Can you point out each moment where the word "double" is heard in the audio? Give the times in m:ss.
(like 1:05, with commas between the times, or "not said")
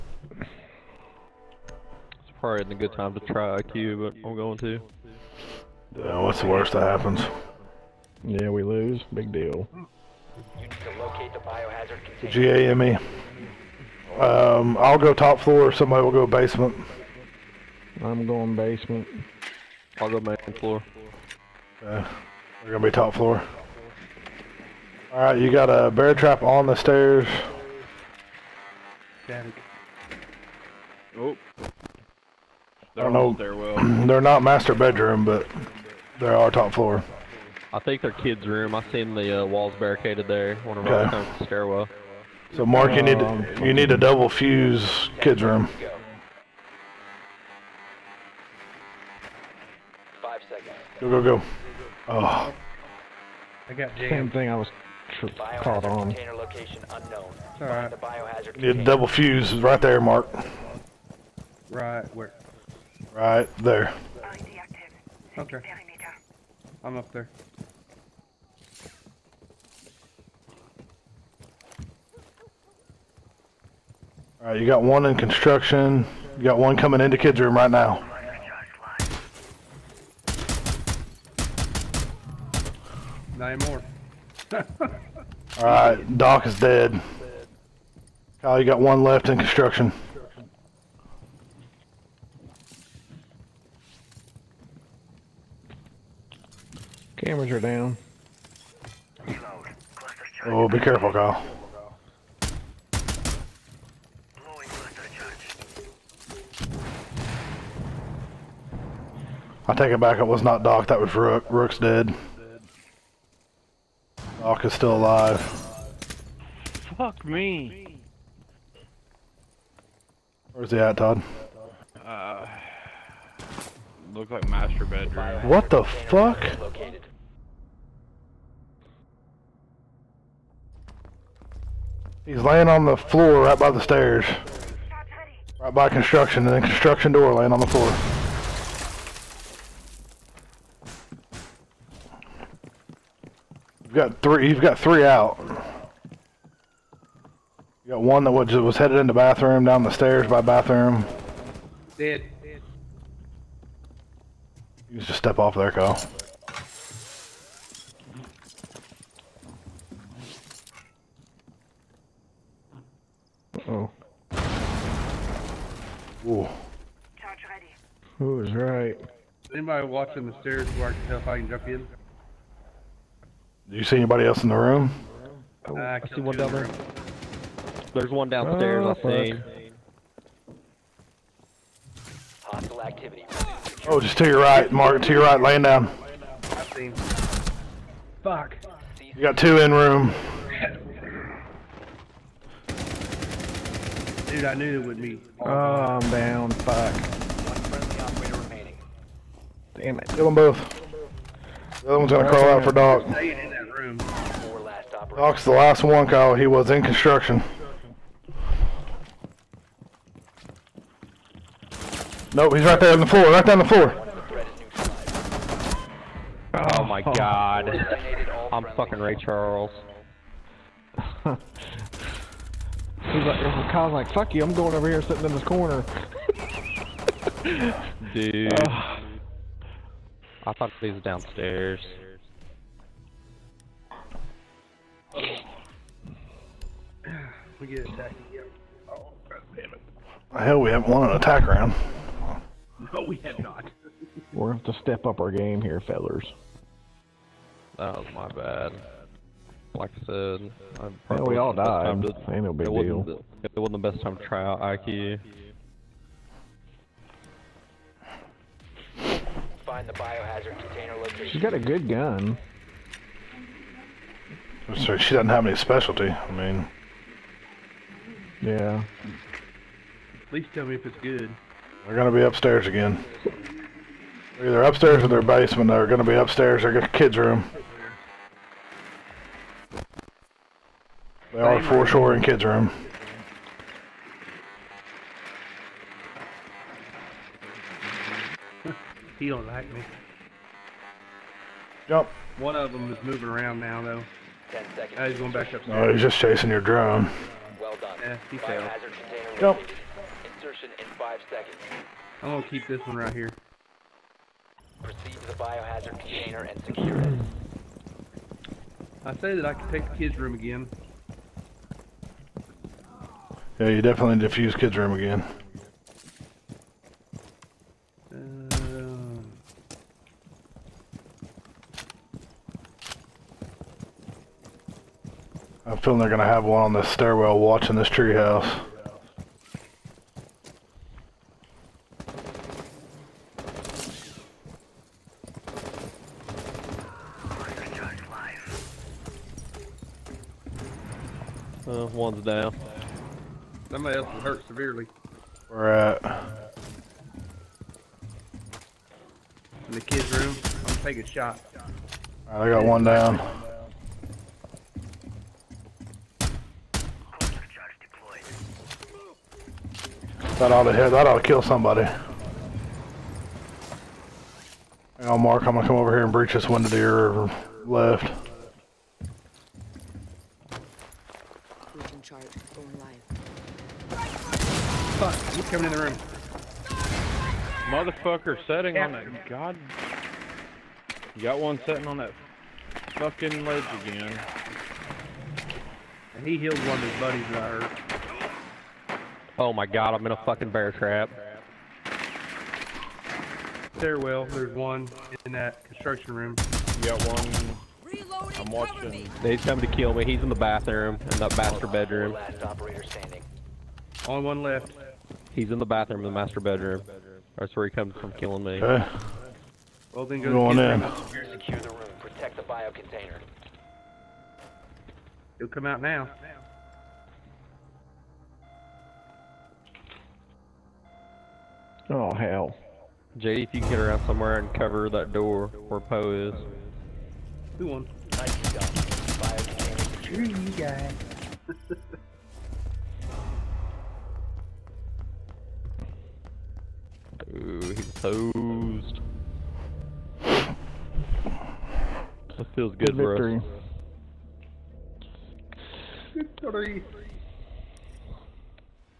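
0:43, 0:58.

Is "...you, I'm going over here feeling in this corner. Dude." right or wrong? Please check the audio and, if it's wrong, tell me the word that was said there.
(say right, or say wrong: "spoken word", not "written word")
wrong: "sitting", not "feeling".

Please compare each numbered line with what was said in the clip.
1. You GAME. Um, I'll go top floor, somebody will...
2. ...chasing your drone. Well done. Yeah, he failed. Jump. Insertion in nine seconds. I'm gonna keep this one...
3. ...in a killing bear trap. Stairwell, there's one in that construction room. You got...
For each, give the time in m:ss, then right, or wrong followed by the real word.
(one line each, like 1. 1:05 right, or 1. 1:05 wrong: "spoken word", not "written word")
1. 0:10 right
2. 4:56 wrong: "five", not "nine"
3. 6:30 wrong: "fucking", not "killing".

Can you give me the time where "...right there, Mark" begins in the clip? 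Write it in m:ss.
0:59.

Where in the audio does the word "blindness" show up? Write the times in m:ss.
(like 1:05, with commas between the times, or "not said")
not said.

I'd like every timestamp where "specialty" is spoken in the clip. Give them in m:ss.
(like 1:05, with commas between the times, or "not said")
4:25.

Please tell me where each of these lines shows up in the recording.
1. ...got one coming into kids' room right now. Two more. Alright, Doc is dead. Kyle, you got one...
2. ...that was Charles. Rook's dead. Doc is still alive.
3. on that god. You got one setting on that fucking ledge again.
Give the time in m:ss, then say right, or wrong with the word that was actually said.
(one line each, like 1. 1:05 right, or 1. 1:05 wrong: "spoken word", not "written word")
1. 1:16 wrong: "Nine", not "Two"
2. 1:50 wrong: "Rook", not "Charles"
3. 6:18 right.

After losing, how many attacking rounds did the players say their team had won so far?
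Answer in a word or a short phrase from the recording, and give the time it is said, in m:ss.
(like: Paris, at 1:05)
0, at 4:00.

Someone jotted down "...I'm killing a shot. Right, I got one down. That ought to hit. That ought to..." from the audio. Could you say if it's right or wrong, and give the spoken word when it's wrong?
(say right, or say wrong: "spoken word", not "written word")
wrong: "taking", not "killing".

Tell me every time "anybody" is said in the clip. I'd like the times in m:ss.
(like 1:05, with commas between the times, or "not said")
2:49, 2:53.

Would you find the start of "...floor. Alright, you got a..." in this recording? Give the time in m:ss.
0:23.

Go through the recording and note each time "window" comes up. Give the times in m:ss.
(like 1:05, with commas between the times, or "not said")
6:06.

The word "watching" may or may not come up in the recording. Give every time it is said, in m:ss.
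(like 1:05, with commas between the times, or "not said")
2:49, 5:27, 6:38.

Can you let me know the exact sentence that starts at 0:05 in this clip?
Yeah, what's the worst that happens?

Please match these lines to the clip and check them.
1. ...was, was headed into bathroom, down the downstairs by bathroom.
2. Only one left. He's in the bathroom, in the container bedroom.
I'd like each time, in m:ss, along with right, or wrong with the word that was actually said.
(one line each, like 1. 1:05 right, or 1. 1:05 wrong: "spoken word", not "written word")
1. 2:28 wrong: "stairs", not "downstairs"
2. 6:44 wrong: "master", not "container".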